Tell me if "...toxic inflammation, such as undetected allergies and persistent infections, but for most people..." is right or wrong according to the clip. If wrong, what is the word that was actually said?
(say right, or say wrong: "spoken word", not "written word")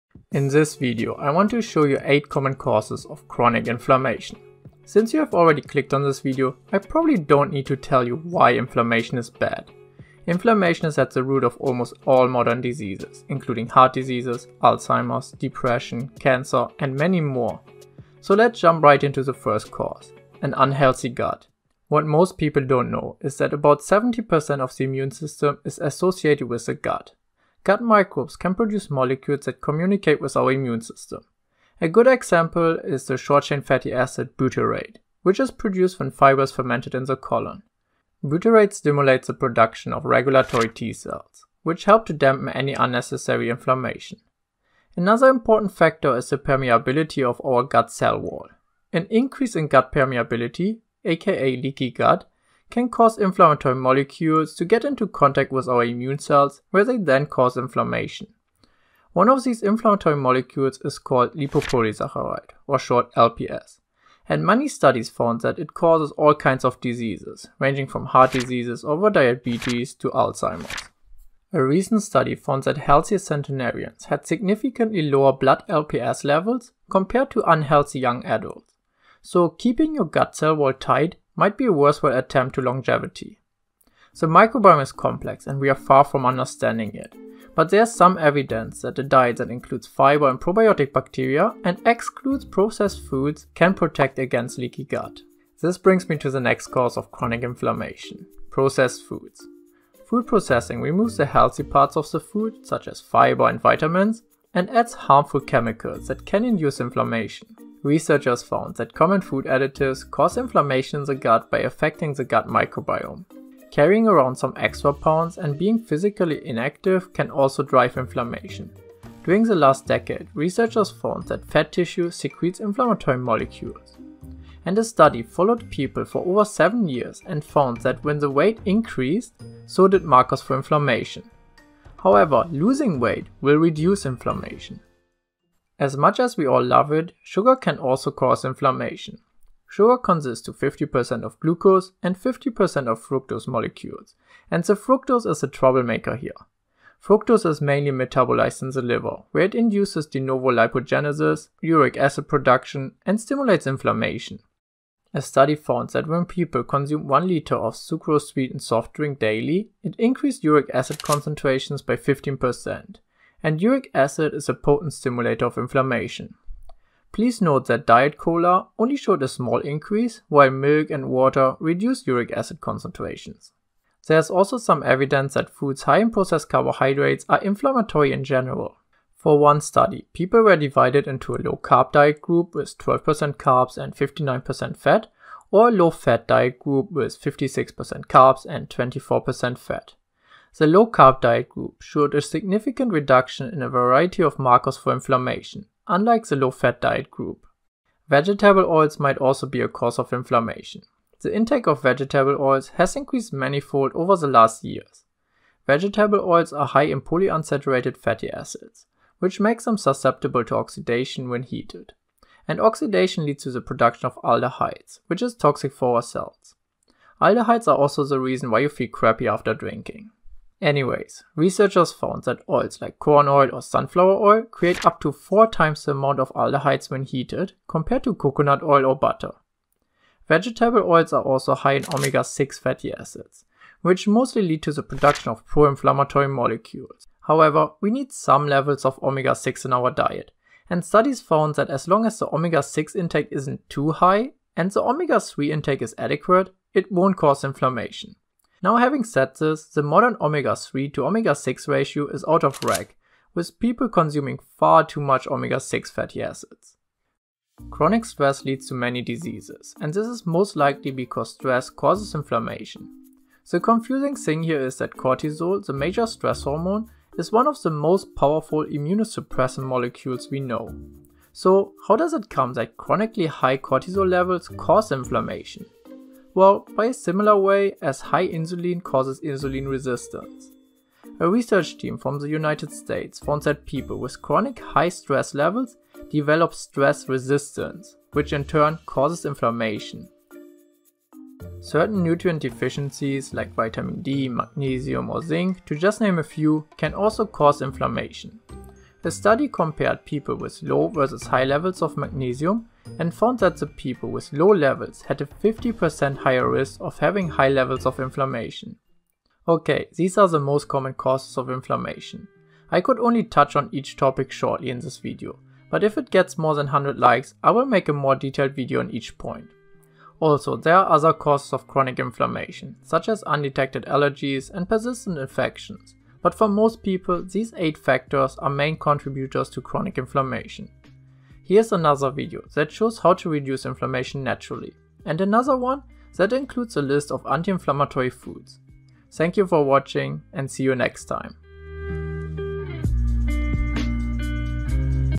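wrong: "chronic", not "toxic".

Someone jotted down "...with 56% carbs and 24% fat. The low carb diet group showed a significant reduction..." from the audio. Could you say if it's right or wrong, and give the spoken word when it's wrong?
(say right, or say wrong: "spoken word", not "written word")
right.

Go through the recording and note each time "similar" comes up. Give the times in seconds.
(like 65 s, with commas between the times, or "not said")
276 s.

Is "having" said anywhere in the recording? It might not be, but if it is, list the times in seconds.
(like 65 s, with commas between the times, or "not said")
248 s, 306 s.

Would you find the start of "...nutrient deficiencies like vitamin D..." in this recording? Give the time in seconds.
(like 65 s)
292 s.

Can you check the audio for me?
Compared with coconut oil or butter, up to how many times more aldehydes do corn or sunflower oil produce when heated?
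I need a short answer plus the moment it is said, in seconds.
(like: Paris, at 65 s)
4 times, at 225 s.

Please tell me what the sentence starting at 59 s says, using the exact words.
One of these inflammatory molecules is called lipopolysaccharide, or short LPS.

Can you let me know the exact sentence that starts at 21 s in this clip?
What most people don't know is that about 70% of the immune system is associated with the gut.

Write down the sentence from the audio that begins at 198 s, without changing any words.
Vegetable oils might also be a cause of inflammation.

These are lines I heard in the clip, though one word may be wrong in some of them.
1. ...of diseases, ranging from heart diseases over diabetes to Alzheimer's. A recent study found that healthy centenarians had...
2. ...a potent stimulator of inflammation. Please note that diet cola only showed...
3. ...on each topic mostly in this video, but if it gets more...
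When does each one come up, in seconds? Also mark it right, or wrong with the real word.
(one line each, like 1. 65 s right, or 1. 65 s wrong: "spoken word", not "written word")
1. 66 s right
2. 164 s right
3. 313 s wrong: "shortly", not "mostly".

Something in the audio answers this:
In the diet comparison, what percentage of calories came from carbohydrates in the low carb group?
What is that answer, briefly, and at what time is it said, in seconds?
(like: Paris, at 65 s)
12%, at 182 s.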